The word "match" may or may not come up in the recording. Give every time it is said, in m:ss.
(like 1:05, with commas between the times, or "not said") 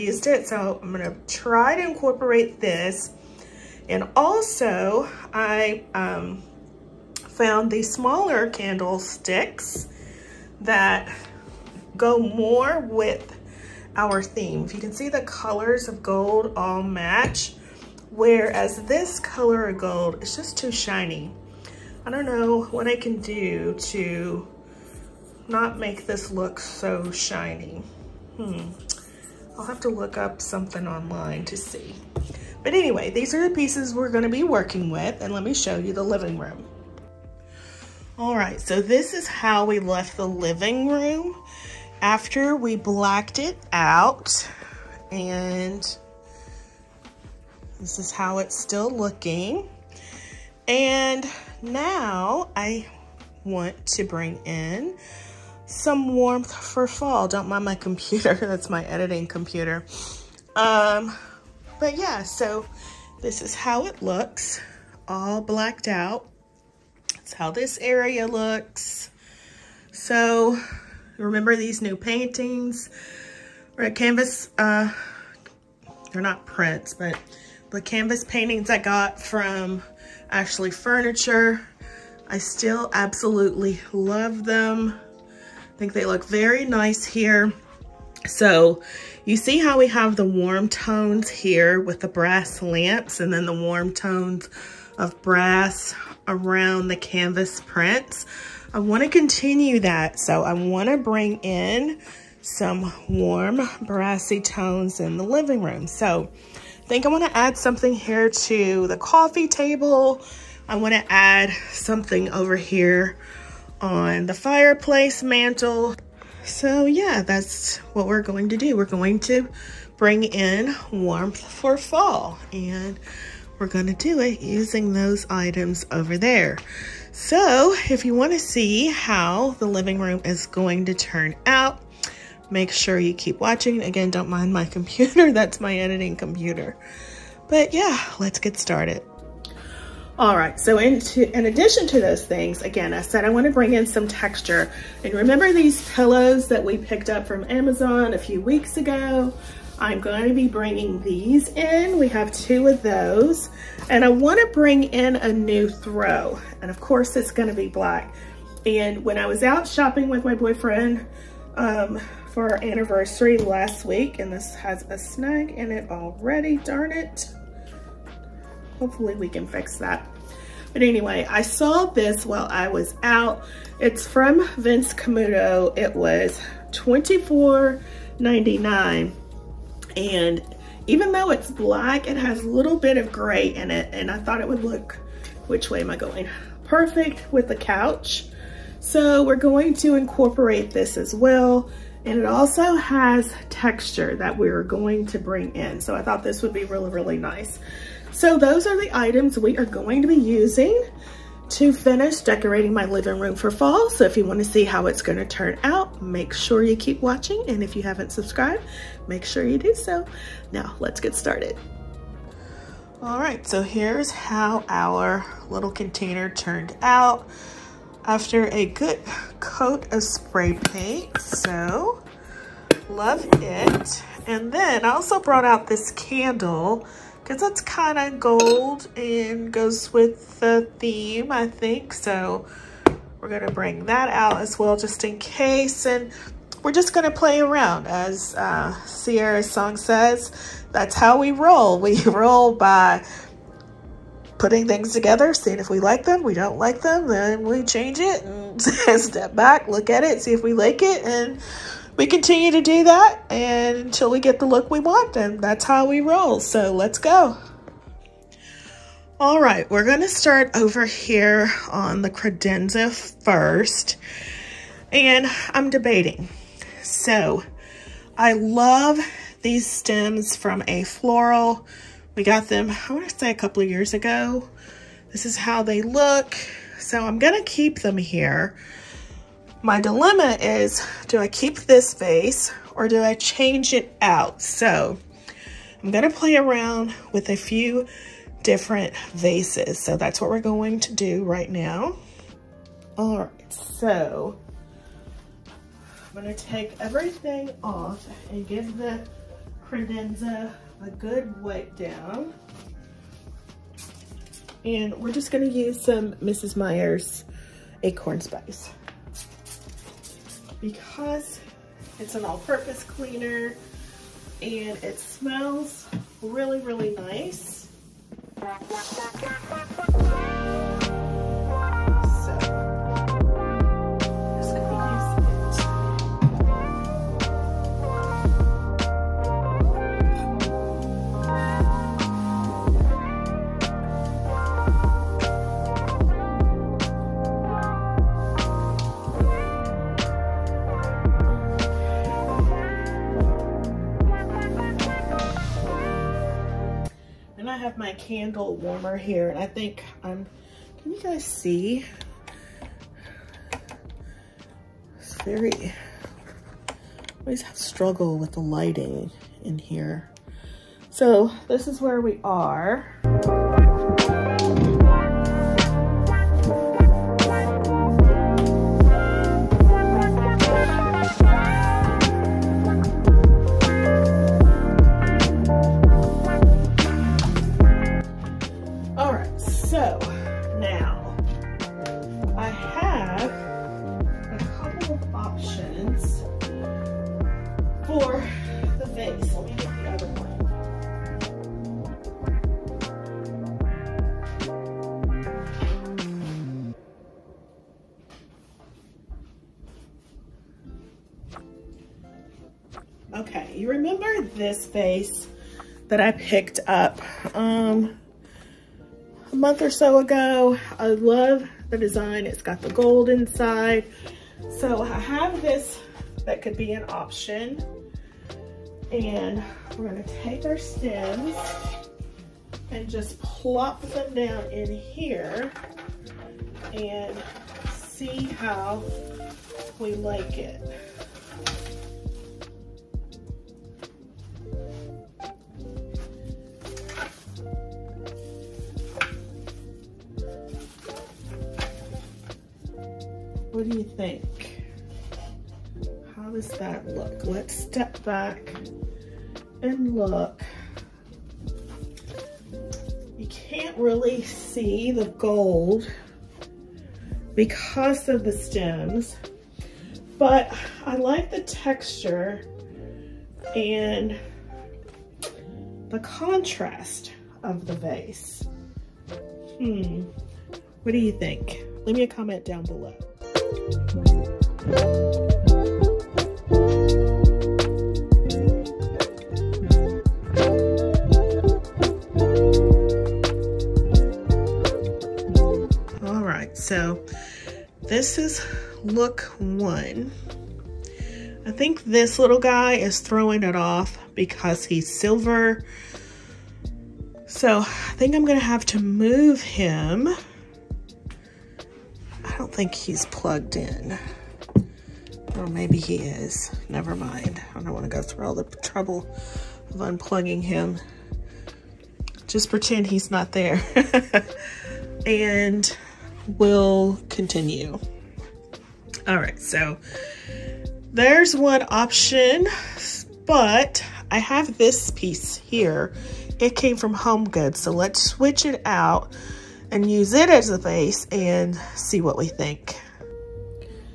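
0:16.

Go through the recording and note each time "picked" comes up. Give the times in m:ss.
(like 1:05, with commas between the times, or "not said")
2:26, 6:46.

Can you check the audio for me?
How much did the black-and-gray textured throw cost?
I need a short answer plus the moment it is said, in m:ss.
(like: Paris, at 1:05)
$24.99, at 2:56.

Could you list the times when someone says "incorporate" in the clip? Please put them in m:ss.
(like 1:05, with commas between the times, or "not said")
0:01, 3:09.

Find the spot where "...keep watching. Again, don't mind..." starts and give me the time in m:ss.
2:13.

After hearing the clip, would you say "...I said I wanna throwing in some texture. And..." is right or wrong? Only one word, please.
wrong.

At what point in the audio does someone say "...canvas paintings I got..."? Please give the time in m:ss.
1:17.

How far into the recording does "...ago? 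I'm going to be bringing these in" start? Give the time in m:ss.
2:28.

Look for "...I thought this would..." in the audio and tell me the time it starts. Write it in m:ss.
3:15.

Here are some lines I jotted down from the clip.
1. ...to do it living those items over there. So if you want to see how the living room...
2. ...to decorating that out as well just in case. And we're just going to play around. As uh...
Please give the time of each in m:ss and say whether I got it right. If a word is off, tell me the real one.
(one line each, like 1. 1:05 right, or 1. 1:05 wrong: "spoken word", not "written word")
1. 2:03 wrong: "using", not "living"
2. 3:53 wrong: "bring", not "decorating".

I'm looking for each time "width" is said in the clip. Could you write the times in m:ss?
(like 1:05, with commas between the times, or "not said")
not said.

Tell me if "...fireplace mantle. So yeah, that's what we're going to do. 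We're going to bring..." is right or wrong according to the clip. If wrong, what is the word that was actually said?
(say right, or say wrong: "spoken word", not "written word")
right.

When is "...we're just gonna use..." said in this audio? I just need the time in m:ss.
5:04.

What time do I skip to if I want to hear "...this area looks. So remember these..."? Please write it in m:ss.
1:07.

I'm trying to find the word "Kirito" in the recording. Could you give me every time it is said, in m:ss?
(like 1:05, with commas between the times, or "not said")
not said.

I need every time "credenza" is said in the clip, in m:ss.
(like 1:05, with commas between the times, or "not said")
4:22, 4:59.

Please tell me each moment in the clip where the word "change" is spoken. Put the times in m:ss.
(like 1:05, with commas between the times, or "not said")
4:07, 4:43.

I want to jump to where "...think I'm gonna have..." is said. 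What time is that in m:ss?
8:17.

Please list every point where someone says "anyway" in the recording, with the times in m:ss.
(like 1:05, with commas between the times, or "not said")
0:32, 2:50.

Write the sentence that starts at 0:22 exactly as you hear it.
I don't know what I can do to not make this look so shiny.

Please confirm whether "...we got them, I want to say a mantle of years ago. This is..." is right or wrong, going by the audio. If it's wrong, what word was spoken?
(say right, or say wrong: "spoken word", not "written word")
wrong: "couple", not "mantle".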